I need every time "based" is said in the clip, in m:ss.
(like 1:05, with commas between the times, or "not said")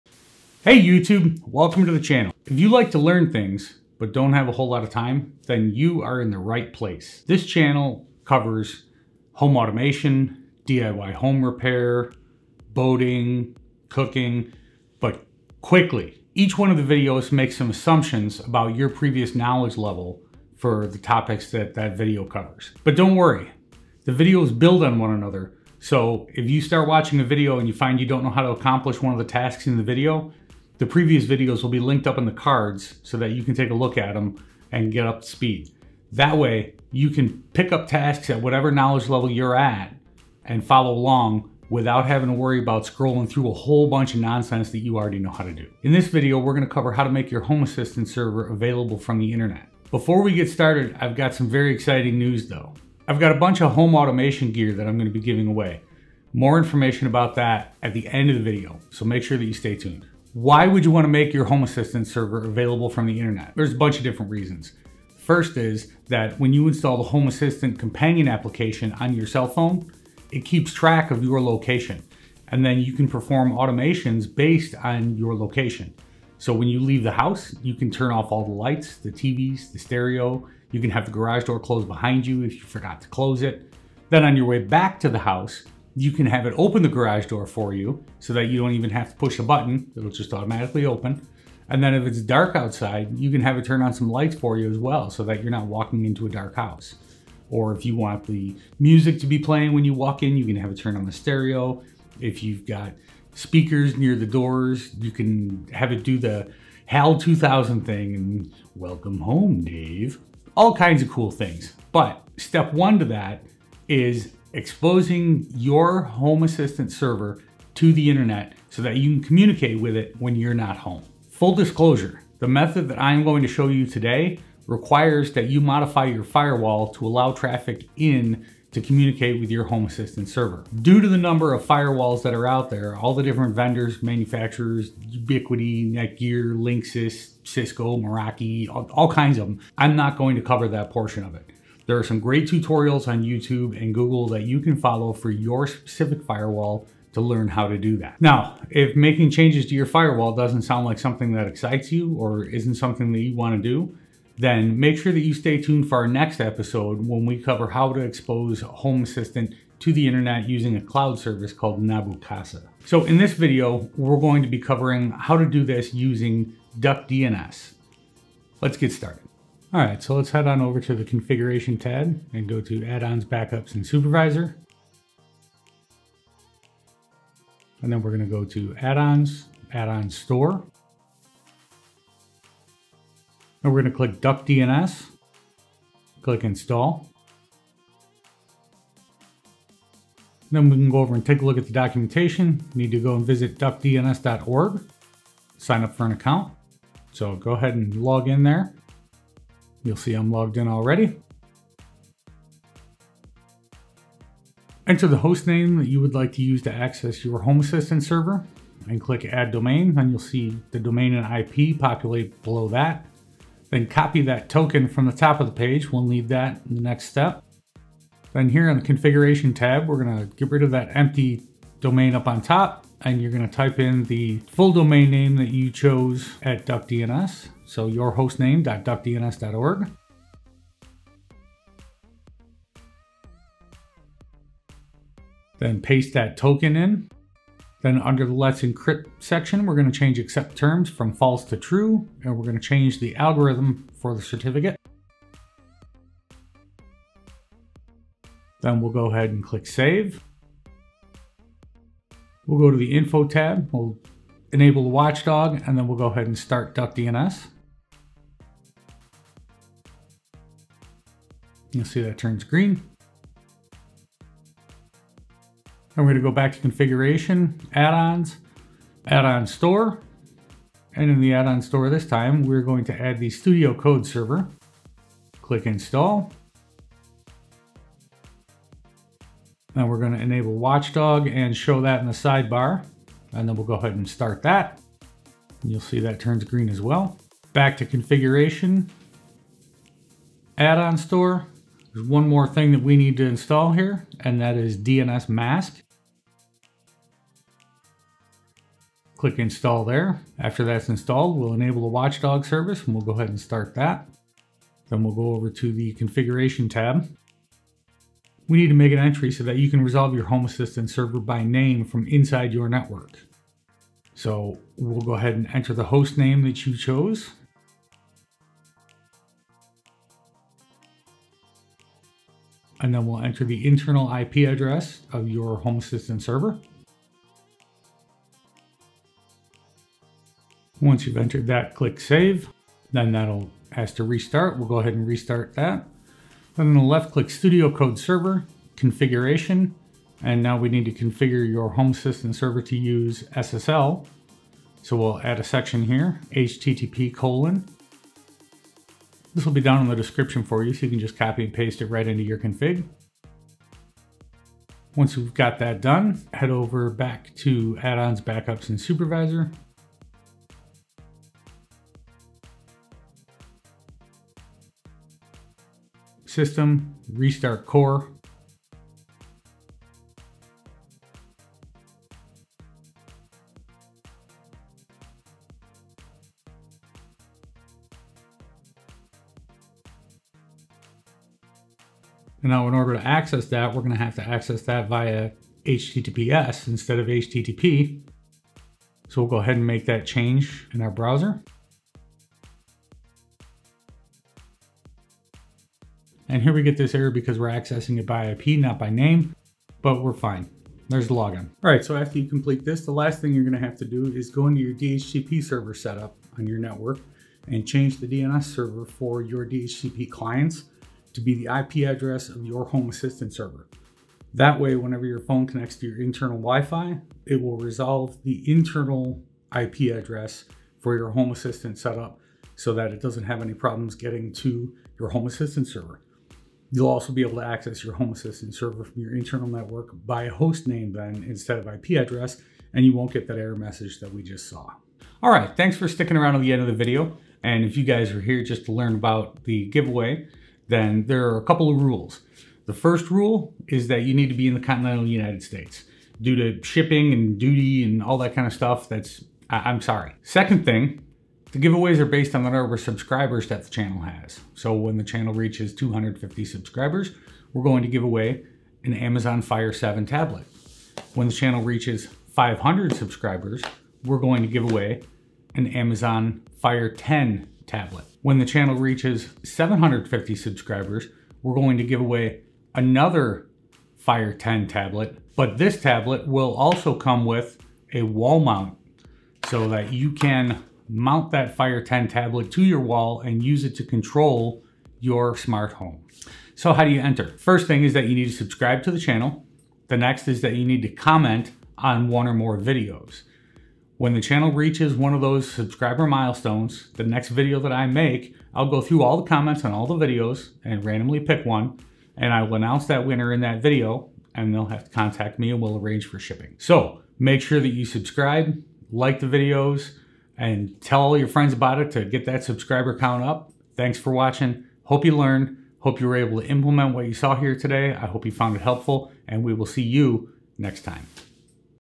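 1:14, 7:32.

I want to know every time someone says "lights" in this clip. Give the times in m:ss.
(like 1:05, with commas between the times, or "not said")
1:18, 1:34.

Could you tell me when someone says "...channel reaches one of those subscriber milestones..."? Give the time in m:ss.
8:14.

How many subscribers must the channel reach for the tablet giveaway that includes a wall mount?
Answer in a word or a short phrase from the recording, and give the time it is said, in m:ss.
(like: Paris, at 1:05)
750, at 7:49.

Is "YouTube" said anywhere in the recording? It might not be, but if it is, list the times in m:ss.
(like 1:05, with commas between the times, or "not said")
0:00, 2:23.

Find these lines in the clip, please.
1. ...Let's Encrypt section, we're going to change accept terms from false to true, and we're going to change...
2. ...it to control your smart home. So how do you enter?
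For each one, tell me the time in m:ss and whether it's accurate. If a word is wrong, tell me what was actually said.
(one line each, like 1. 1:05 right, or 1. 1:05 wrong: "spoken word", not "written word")
1. 3:58 right
2. 8:03 right.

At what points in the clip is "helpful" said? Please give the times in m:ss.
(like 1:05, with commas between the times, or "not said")
8:38.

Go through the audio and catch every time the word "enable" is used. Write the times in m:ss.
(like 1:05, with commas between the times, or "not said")
4:14, 4:40, 5:01.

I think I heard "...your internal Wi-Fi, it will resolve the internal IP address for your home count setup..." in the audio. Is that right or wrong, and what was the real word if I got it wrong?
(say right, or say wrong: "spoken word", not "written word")
wrong: "assistant", not "count".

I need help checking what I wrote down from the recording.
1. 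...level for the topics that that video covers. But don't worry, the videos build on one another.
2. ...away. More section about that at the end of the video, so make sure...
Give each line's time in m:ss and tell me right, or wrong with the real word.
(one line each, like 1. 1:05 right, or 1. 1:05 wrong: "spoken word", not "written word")
1. 0:19 right
2. 0:55 wrong: "information", not "section".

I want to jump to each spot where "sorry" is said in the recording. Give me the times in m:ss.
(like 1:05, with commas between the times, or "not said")
7:29.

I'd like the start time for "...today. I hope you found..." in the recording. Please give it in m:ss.
8:37.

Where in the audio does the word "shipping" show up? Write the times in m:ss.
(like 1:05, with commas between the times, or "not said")
7:26, 8:26.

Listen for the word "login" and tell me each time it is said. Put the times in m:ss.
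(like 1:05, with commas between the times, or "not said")
6:41.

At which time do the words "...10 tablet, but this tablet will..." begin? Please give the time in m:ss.
7:54.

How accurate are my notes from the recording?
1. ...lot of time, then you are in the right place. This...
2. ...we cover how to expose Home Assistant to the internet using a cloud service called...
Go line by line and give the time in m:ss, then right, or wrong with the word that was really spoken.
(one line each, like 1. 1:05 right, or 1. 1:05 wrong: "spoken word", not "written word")
1. 0:04 right
2. 2:37 right.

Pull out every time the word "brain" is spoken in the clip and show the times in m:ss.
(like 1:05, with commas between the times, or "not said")
not said.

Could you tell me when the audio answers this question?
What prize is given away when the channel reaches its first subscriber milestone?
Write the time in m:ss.
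7:38.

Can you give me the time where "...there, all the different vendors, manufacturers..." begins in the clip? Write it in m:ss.
2:12.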